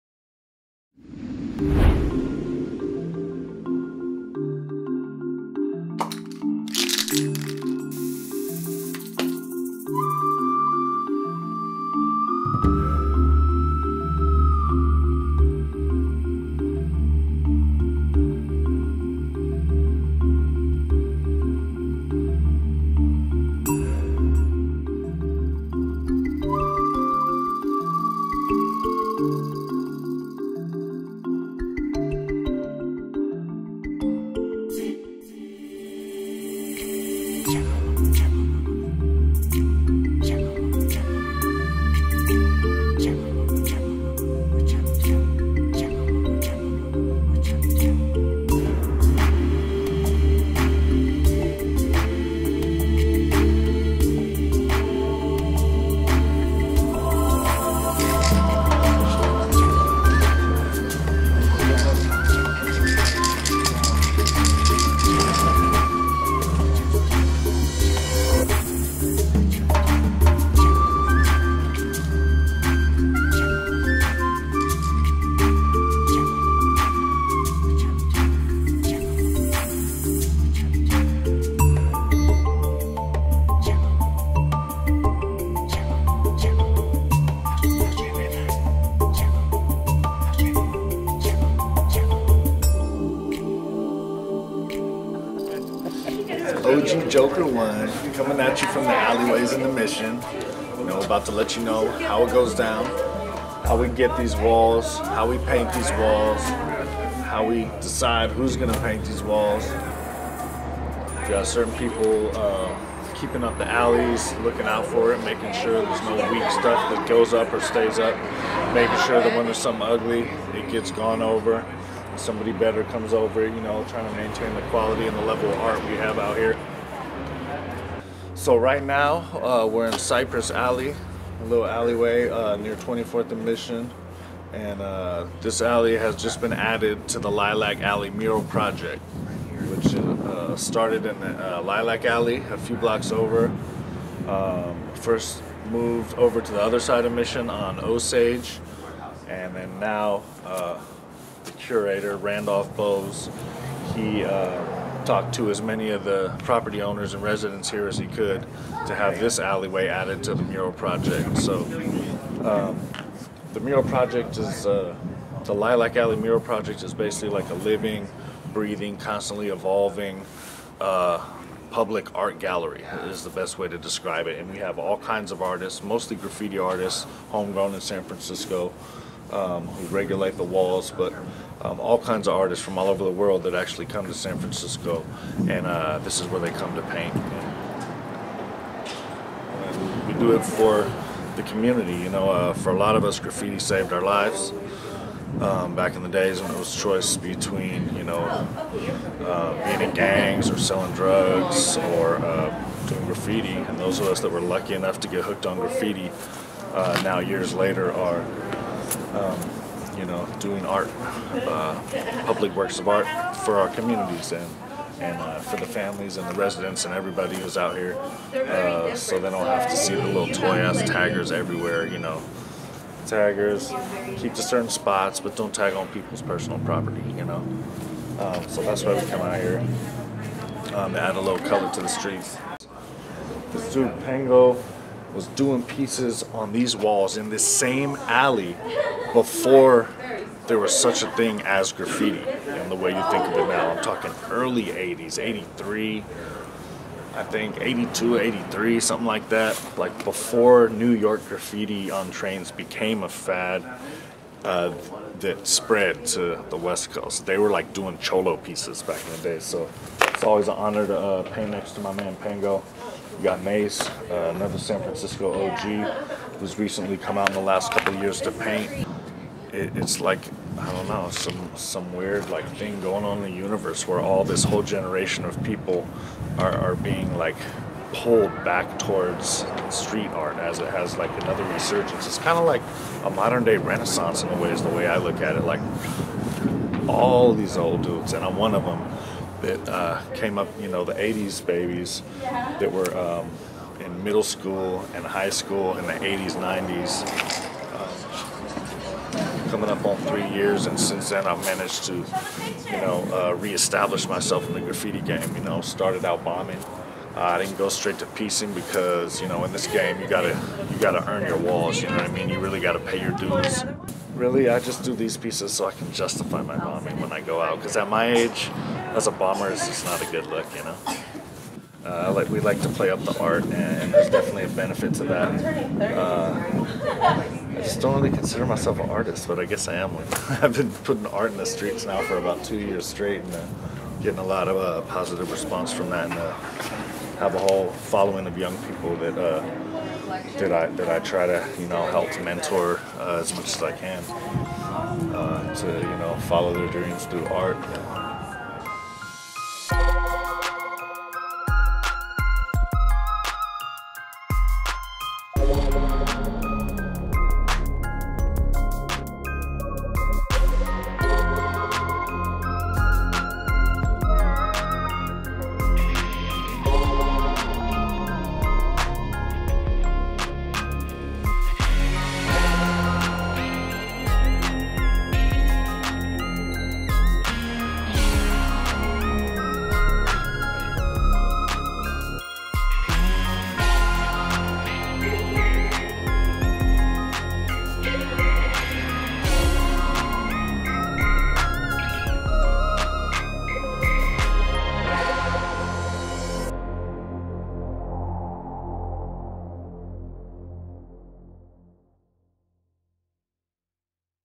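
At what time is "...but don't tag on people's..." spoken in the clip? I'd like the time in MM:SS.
03:45.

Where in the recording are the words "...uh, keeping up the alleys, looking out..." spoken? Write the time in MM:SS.
01:52.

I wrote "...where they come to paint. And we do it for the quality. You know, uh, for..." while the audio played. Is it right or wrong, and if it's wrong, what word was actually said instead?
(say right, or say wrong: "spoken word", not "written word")
wrong: "community", not "quality".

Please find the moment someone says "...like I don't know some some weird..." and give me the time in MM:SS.
04:30.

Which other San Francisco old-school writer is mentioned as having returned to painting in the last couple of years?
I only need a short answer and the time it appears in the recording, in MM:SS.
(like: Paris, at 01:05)
Mace, at 04:23.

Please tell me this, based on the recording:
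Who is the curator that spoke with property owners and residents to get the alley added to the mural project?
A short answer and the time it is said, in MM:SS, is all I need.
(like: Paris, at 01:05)
Randolph Bowes, at 02:32.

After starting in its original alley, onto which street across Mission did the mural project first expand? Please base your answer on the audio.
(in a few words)
Osage.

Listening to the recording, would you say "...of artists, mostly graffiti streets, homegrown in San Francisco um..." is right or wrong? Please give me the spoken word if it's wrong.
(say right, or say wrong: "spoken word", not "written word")
wrong: "artists", not "streets".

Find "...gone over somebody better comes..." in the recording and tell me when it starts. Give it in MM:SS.
02:00.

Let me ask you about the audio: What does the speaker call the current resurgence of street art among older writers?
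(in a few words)
a modern day renaissance.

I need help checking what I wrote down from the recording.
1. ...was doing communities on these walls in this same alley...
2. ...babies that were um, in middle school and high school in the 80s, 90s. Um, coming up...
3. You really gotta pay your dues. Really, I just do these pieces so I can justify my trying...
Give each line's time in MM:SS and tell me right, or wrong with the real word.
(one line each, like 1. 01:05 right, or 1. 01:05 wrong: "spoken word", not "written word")
1. 03:55 wrong: "pieces", not "communities"
2. 04:51 right
3. 05:12 wrong: "bombing", not "trying".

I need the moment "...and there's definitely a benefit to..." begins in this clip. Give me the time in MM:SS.
05:23.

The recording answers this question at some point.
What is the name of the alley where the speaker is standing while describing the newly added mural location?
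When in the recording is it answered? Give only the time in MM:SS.
02:09.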